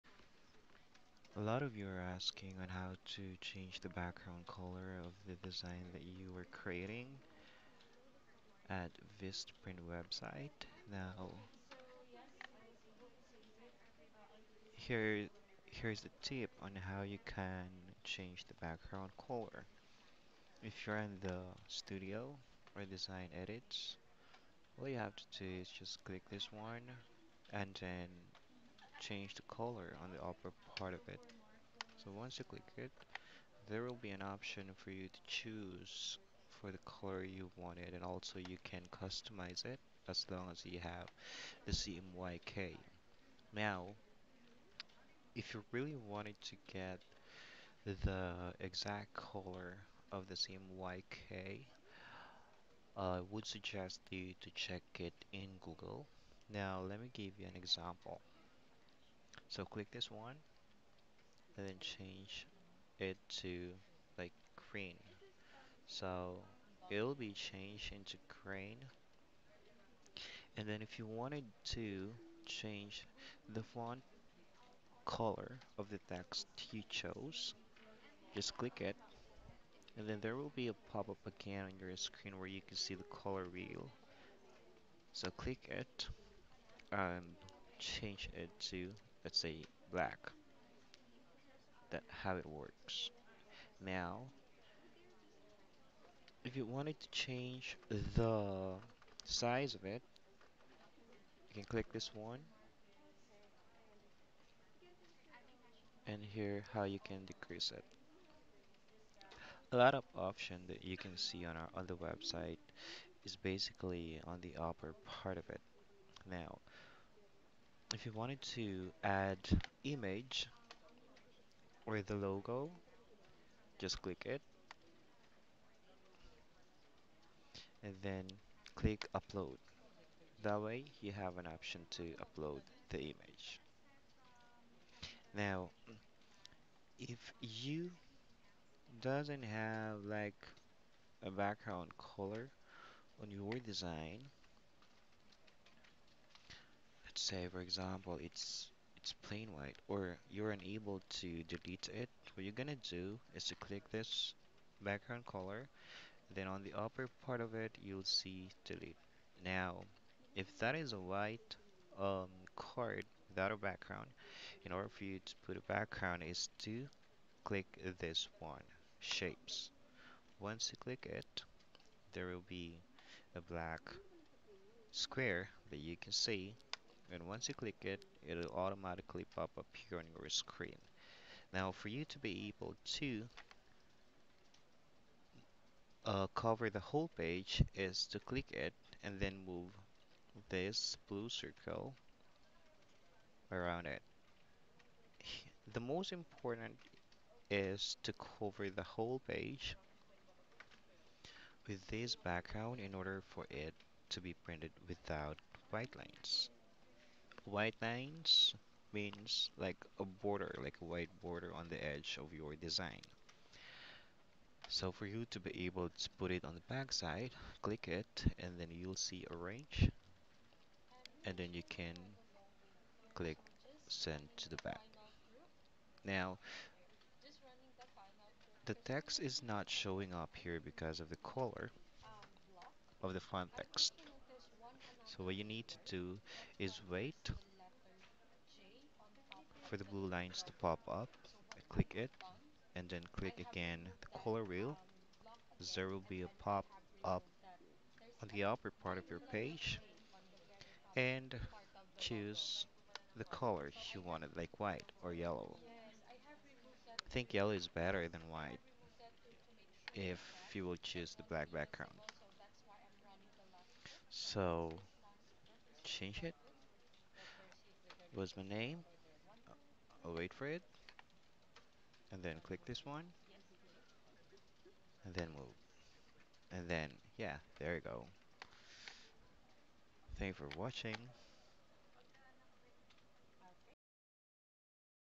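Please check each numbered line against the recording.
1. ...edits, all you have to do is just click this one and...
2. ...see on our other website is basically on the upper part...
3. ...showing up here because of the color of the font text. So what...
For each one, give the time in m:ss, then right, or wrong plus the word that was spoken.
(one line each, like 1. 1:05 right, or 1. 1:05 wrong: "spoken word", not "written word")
1. 0:23 right
2. 1:51 right
3. 3:49 right.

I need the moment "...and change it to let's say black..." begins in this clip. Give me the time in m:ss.
1:26.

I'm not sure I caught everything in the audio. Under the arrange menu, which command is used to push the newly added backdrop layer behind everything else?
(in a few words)
Send to the back.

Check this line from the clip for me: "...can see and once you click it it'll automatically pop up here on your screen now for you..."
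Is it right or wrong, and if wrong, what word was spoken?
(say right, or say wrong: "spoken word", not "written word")
right.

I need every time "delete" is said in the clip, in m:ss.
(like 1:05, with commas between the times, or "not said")
2:31, 2:38.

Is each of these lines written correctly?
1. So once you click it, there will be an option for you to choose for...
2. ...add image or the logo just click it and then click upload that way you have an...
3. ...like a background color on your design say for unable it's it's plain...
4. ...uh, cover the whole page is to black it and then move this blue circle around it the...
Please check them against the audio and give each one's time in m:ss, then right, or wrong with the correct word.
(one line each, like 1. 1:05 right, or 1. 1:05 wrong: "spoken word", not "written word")
1. 0:32 right
2. 1:59 right
3. 2:20 wrong: "example", not "unable"
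4. 3:06 wrong: "click", not "black".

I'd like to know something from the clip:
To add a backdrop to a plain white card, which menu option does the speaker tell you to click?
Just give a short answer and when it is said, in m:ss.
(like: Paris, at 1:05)
Shapes, at 2:49.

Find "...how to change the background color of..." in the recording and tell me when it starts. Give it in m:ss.
0:02.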